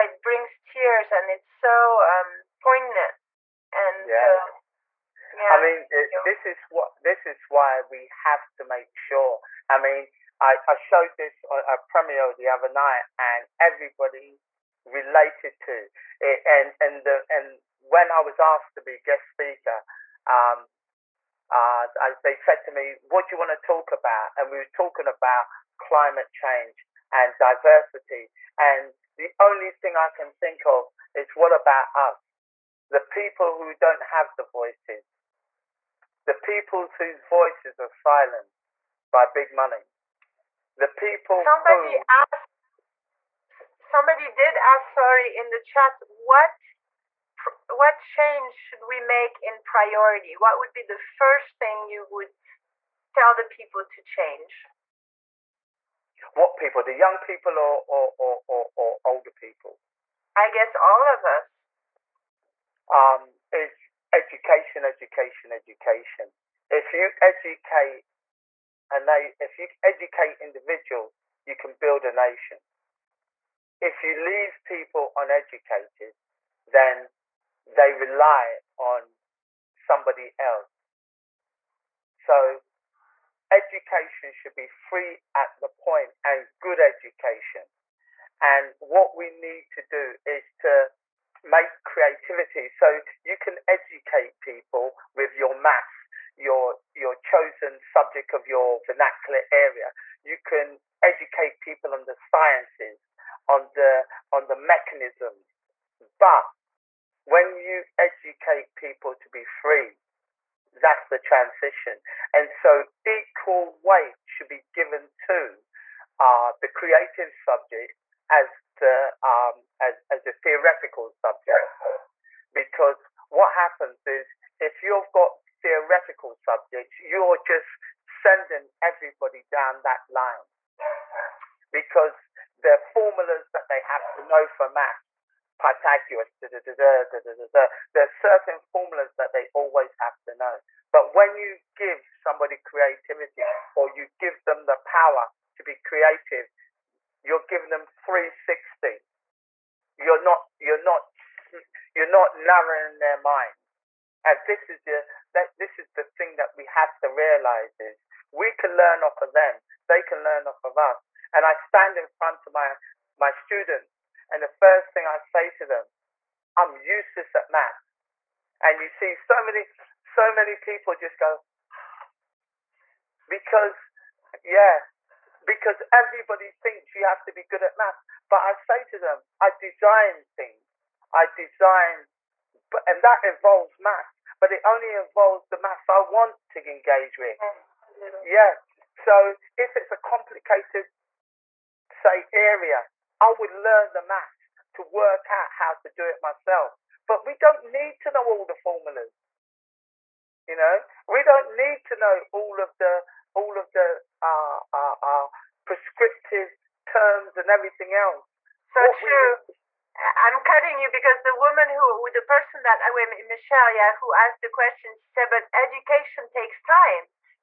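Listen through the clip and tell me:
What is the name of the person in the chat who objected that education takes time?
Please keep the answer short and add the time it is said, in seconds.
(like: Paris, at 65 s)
Michelle, at 213 s.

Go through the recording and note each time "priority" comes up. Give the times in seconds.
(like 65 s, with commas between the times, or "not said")
49 s.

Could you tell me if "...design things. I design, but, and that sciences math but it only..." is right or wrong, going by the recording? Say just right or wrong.
wrong.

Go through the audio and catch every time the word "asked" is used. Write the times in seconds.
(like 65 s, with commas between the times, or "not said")
18 s, 42 s, 214 s.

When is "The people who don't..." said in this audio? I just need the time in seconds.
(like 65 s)
32 s.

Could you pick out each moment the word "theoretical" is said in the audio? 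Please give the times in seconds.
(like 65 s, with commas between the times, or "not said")
120 s, 125 s.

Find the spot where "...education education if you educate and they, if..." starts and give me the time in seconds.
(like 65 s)
64 s.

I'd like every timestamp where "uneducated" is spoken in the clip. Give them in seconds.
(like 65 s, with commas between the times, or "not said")
75 s.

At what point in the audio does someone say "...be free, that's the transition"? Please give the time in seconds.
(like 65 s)
109 s.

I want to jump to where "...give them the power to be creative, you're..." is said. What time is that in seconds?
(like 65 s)
144 s.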